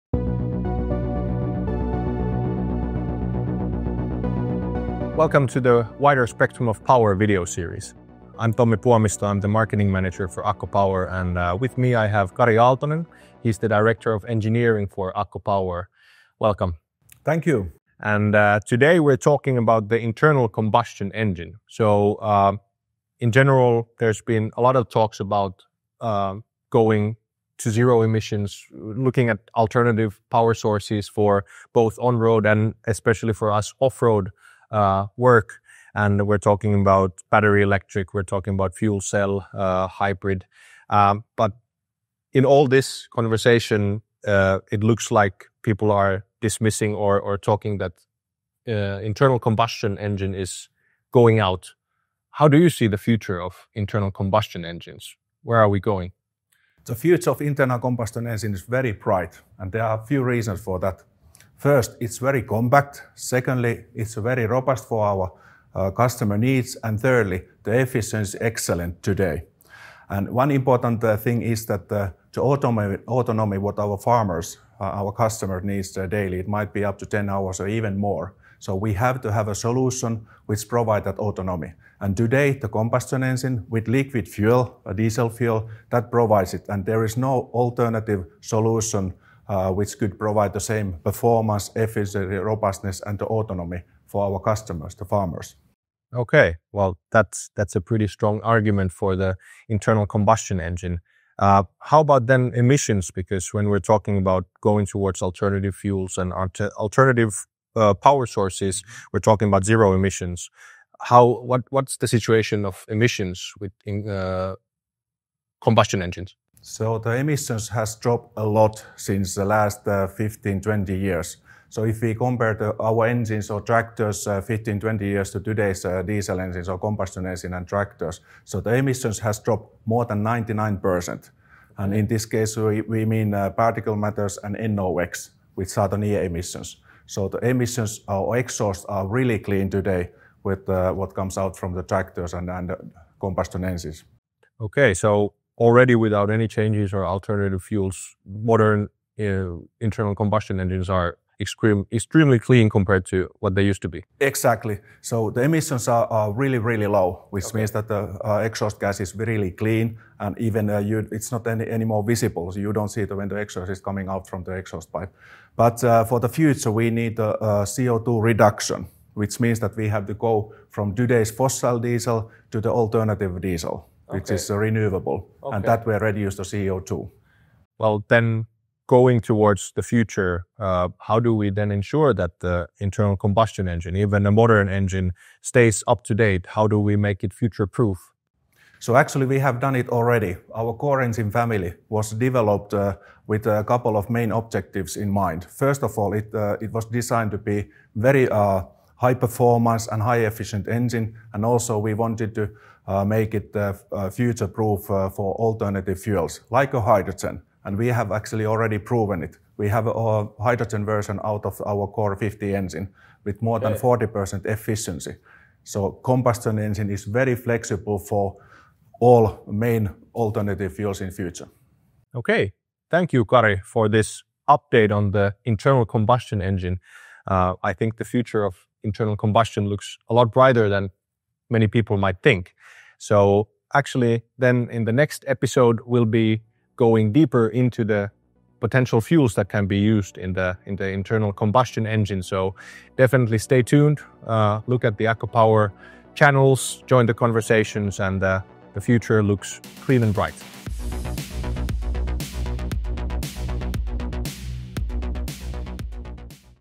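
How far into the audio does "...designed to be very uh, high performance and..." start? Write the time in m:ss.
3:16.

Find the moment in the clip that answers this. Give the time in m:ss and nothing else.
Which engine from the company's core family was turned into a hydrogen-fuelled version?
3:31.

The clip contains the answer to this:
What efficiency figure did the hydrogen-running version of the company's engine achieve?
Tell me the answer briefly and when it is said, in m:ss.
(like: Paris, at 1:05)
more than 40%, at 3:33.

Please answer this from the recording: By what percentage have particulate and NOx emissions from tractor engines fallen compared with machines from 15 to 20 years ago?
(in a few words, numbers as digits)
more than 99%.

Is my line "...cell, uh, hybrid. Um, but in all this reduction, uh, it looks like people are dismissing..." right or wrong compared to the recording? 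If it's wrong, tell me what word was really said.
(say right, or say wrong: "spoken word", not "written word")
wrong: "conversation", not "reduction".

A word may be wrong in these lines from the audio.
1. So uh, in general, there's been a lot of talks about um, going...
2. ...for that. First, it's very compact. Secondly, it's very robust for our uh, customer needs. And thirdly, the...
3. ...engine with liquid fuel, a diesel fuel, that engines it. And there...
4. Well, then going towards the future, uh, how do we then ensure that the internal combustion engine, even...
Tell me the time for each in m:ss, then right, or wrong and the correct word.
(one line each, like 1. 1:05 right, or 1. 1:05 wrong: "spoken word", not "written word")
1. 0:21 right
2. 1:00 right
3. 1:23 wrong: "provides", not "engines"
4. 2:57 right.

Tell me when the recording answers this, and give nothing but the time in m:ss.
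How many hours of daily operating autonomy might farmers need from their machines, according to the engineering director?
1:17.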